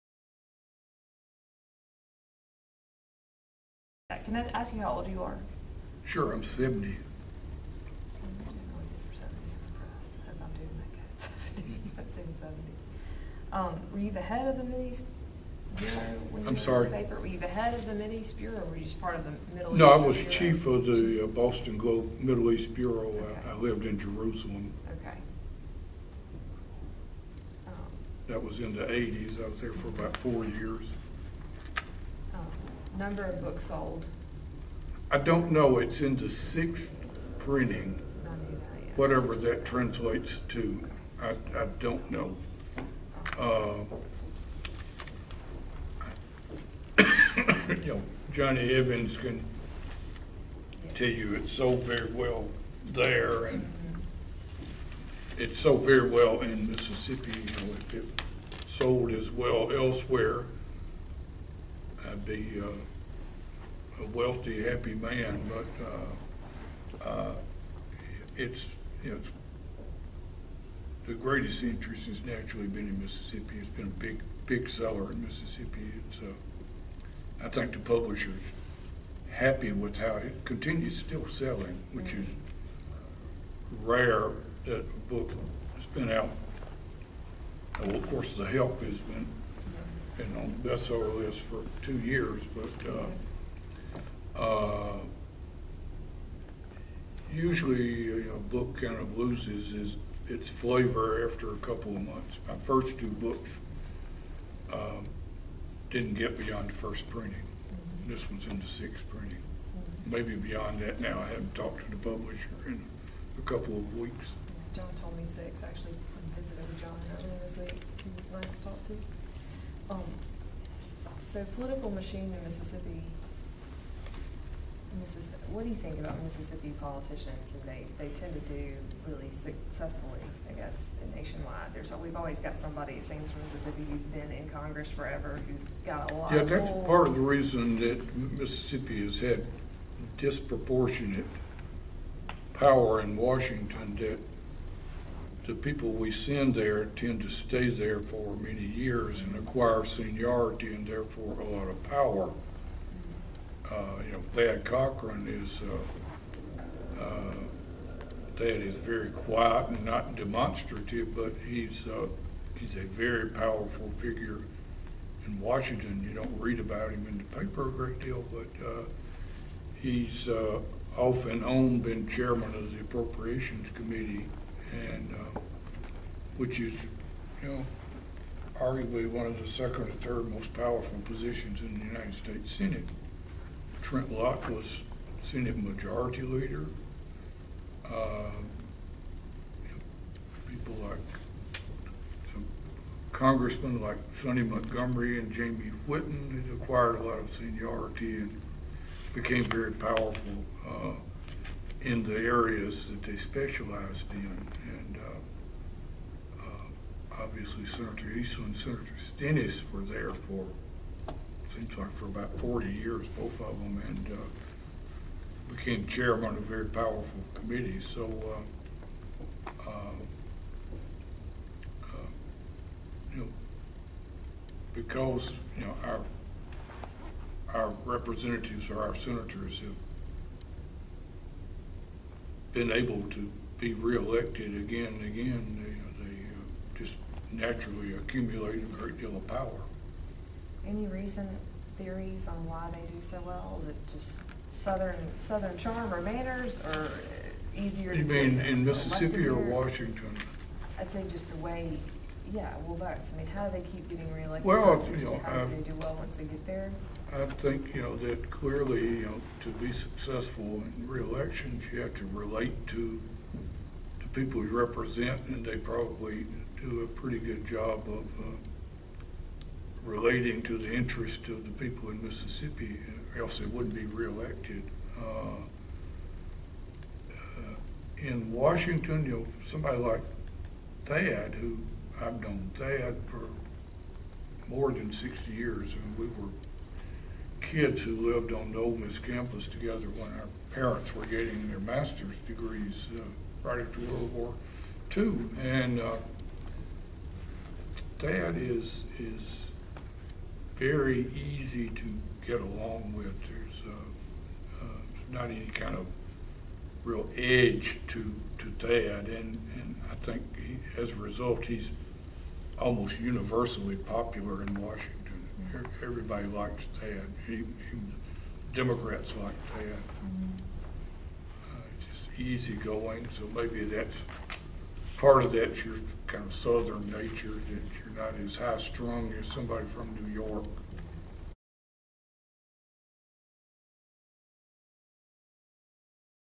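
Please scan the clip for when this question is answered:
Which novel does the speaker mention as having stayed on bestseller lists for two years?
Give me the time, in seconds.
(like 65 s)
88 s.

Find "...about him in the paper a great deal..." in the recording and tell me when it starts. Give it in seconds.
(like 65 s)
166 s.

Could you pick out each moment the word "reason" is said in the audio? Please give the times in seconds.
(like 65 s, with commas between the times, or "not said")
137 s.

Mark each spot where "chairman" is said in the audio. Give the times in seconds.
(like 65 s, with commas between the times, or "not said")
172 s, 215 s.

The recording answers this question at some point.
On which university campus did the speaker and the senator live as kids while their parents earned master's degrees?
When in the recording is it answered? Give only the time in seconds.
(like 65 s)
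288 s.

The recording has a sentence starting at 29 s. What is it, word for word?
I was there for about four years number of books sold?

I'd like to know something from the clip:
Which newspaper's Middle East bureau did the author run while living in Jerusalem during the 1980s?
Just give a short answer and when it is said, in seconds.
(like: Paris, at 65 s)
Boston Globe, at 21 s.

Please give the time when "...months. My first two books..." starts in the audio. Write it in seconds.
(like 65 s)
102 s.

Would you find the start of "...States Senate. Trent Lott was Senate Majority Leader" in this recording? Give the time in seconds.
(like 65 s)
182 s.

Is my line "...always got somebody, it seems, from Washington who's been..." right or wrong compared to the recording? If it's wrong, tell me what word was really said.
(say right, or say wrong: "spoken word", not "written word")
wrong: "Mississippi", not "Washington".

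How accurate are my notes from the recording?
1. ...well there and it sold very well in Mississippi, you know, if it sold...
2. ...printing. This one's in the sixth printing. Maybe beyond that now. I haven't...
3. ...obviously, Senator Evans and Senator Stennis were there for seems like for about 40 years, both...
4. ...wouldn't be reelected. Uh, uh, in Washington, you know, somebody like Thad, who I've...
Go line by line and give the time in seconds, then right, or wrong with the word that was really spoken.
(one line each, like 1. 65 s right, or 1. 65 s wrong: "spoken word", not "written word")
1. 52 s right
2. 107 s right
3. 207 s wrong: "Eastland", not "Evans"
4. 273 s right.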